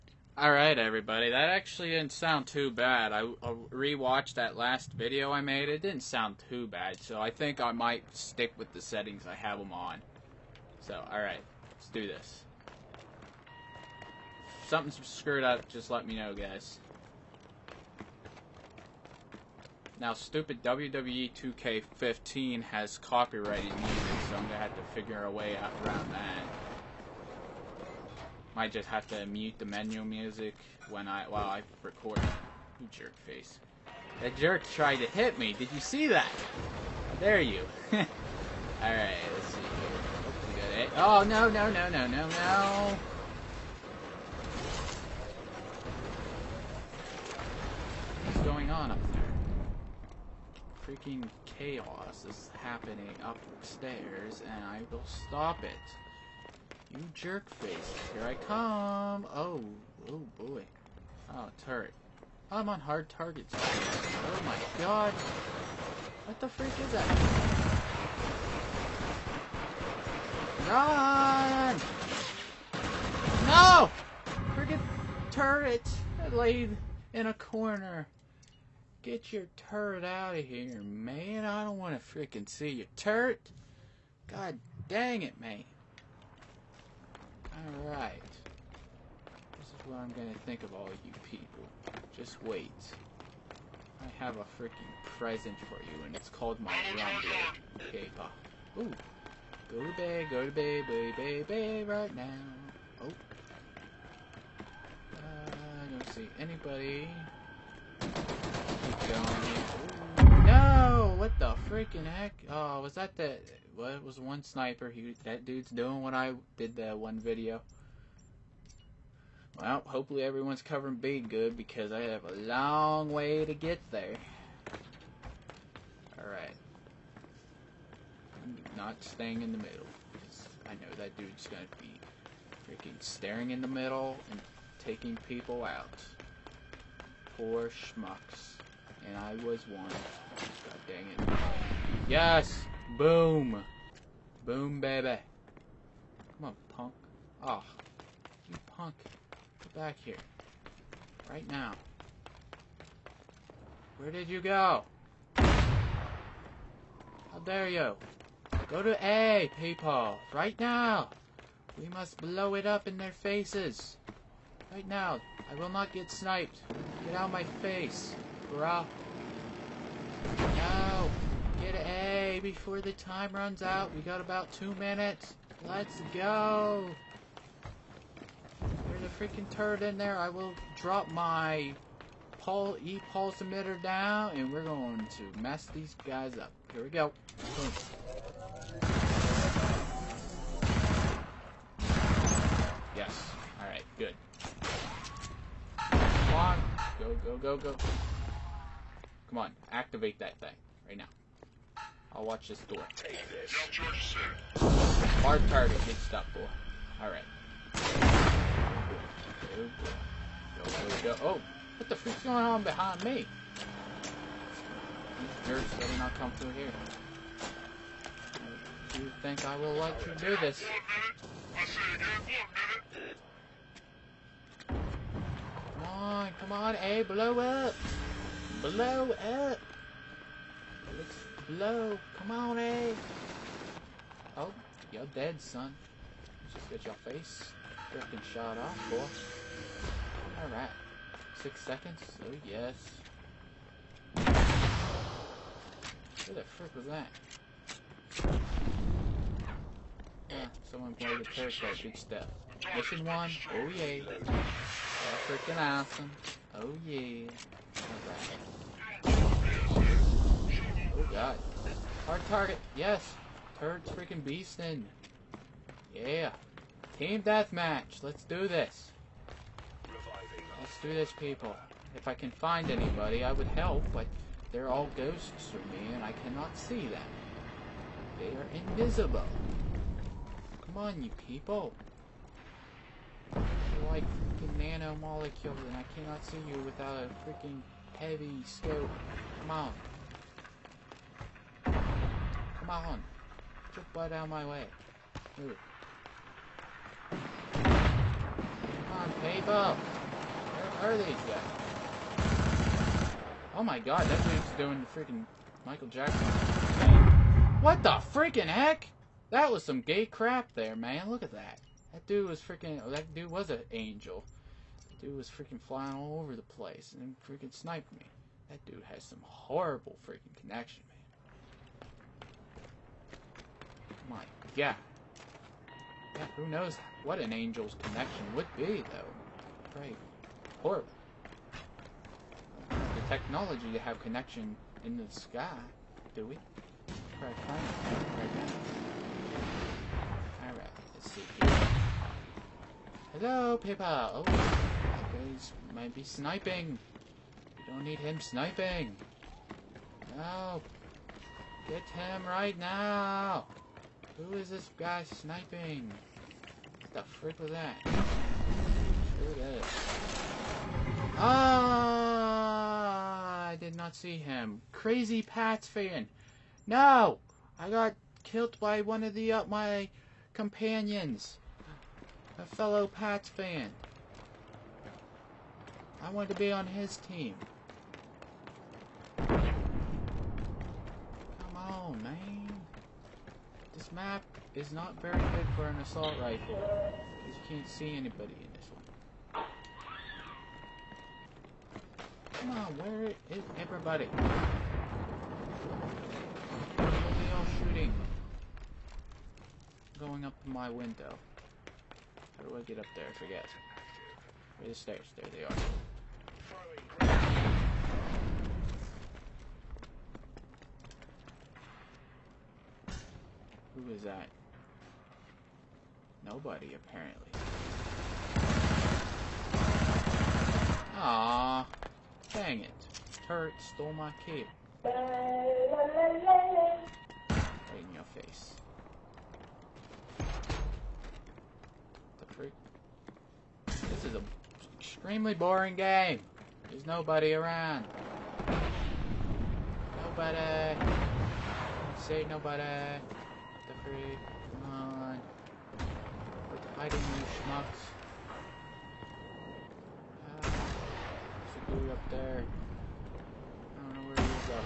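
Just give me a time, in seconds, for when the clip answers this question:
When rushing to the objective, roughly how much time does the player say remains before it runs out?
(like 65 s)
174 s.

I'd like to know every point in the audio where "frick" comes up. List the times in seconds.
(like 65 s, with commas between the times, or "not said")
246 s, 357 s.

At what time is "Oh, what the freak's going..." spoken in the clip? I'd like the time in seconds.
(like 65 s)
211 s.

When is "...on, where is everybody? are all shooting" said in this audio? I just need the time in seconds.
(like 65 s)
392 s.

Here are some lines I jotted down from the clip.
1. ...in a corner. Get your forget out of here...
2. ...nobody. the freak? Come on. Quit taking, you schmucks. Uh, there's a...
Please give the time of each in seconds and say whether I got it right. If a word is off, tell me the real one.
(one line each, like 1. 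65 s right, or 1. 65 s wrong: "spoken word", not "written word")
1. 77 s wrong: "turret", not "forget"
2. 442 s wrong: "hiding", not "taking".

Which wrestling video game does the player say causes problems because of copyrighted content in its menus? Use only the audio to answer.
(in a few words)
WWE 2K15.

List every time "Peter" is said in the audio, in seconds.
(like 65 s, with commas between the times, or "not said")
not said.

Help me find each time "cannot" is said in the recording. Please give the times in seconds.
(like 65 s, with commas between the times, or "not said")
276 s, 285 s.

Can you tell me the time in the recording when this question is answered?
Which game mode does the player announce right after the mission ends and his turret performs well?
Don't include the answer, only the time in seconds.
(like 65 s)
266 s.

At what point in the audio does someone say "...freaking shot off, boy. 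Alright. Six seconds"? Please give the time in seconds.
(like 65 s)
237 s.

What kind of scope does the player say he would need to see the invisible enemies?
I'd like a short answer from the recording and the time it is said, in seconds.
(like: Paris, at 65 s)
heavy scope, at 287 s.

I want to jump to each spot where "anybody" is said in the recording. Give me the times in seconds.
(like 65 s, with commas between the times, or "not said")
106 s, 272 s, 387 s.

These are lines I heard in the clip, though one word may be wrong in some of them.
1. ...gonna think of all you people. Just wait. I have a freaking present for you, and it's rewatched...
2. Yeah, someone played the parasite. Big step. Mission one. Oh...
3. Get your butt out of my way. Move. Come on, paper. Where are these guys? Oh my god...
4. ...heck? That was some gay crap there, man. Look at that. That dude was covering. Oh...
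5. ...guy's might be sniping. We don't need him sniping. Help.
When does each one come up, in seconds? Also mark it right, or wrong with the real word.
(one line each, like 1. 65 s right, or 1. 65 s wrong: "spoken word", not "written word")
1. 90 s wrong: "called", not "rewatched"
2. 250 s right
3. 293 s right
4. 308 s wrong: "freaking", not "covering"
5. 344 s right.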